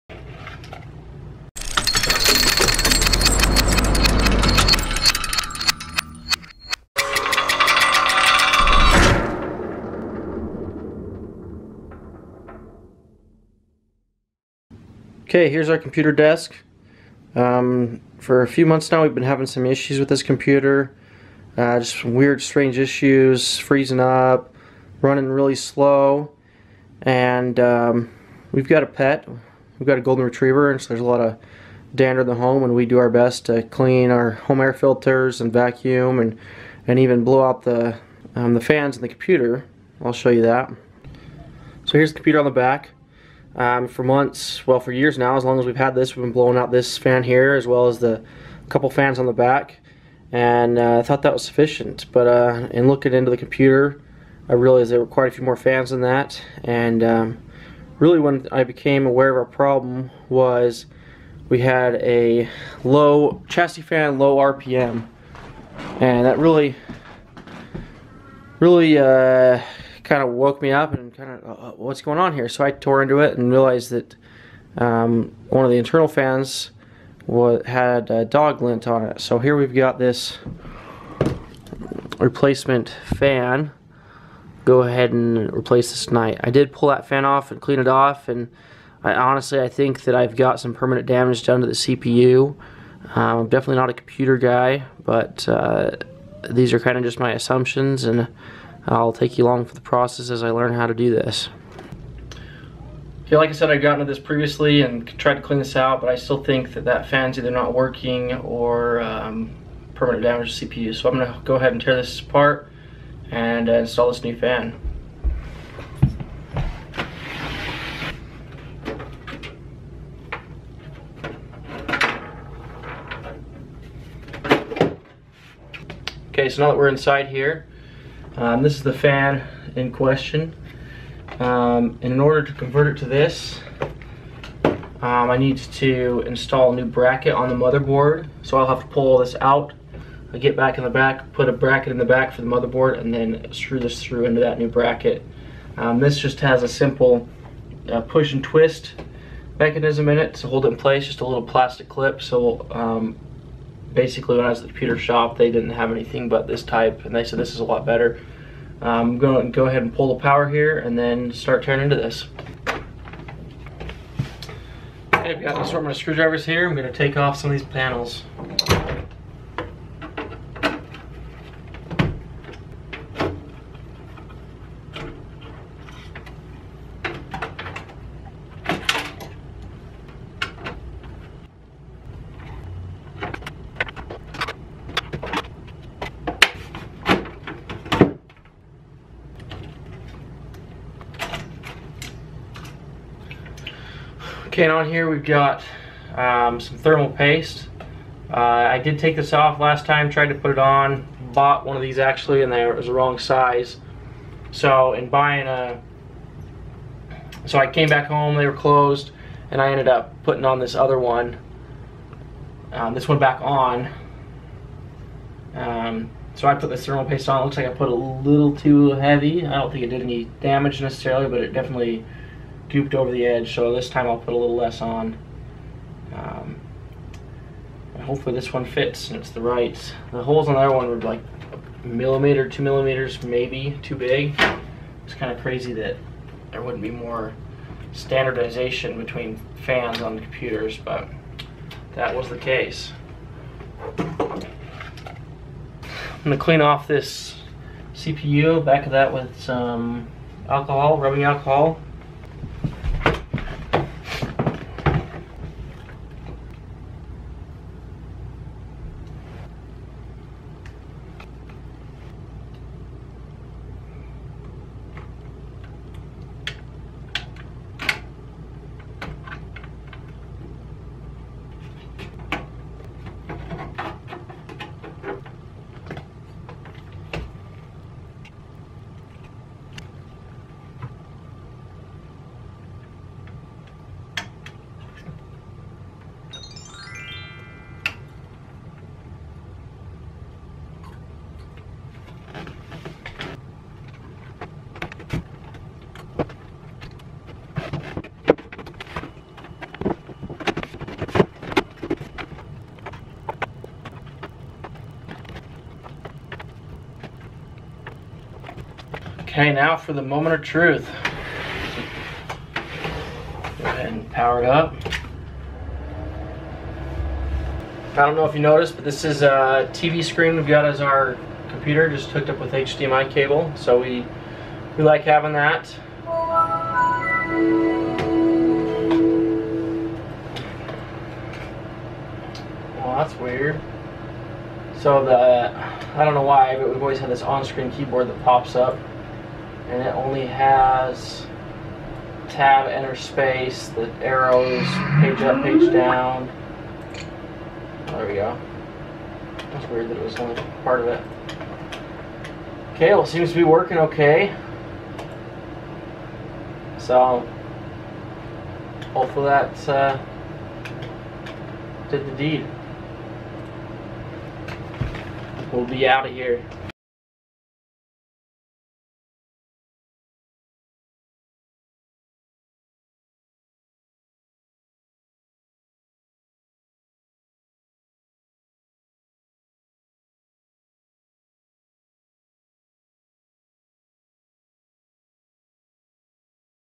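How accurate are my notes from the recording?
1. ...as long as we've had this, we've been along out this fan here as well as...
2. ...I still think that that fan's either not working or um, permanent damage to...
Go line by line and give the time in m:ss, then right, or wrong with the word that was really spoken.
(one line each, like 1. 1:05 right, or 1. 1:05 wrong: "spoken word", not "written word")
1. 0:45 wrong: "blowing", not "along"
2. 1:46 right.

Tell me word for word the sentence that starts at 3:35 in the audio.
Um, so I put the thermal paste on, it looks like I put a little too heavy.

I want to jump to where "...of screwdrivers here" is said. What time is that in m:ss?
2:45.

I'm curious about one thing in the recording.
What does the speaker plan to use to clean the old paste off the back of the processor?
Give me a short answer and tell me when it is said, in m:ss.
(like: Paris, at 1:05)
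rubbing alcohol, at 4:10.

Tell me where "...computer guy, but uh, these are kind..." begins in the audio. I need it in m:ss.
1:33.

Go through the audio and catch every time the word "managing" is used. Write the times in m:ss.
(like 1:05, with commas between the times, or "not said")
not said.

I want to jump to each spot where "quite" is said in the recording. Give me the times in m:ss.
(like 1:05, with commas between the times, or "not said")
0:55.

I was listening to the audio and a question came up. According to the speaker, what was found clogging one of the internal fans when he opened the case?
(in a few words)
dog lint.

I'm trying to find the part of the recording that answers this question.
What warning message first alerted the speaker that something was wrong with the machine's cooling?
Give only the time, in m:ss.
1:02.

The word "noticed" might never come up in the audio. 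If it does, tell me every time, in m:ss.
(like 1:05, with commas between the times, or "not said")
5:18.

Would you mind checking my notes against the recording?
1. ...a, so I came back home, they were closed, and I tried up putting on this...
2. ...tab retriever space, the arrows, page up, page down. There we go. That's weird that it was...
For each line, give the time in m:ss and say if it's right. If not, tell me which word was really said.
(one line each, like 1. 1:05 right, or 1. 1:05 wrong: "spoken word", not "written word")
1. 3:25 wrong: "ended", not "tried"
2. 5:42 wrong: "enter", not "retriever".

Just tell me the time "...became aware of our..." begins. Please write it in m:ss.
0:58.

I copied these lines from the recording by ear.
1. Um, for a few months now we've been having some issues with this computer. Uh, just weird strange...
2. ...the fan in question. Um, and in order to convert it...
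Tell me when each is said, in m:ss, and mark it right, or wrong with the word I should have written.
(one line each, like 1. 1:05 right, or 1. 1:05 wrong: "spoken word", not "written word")
1. 0:17 right
2. 2:08 right.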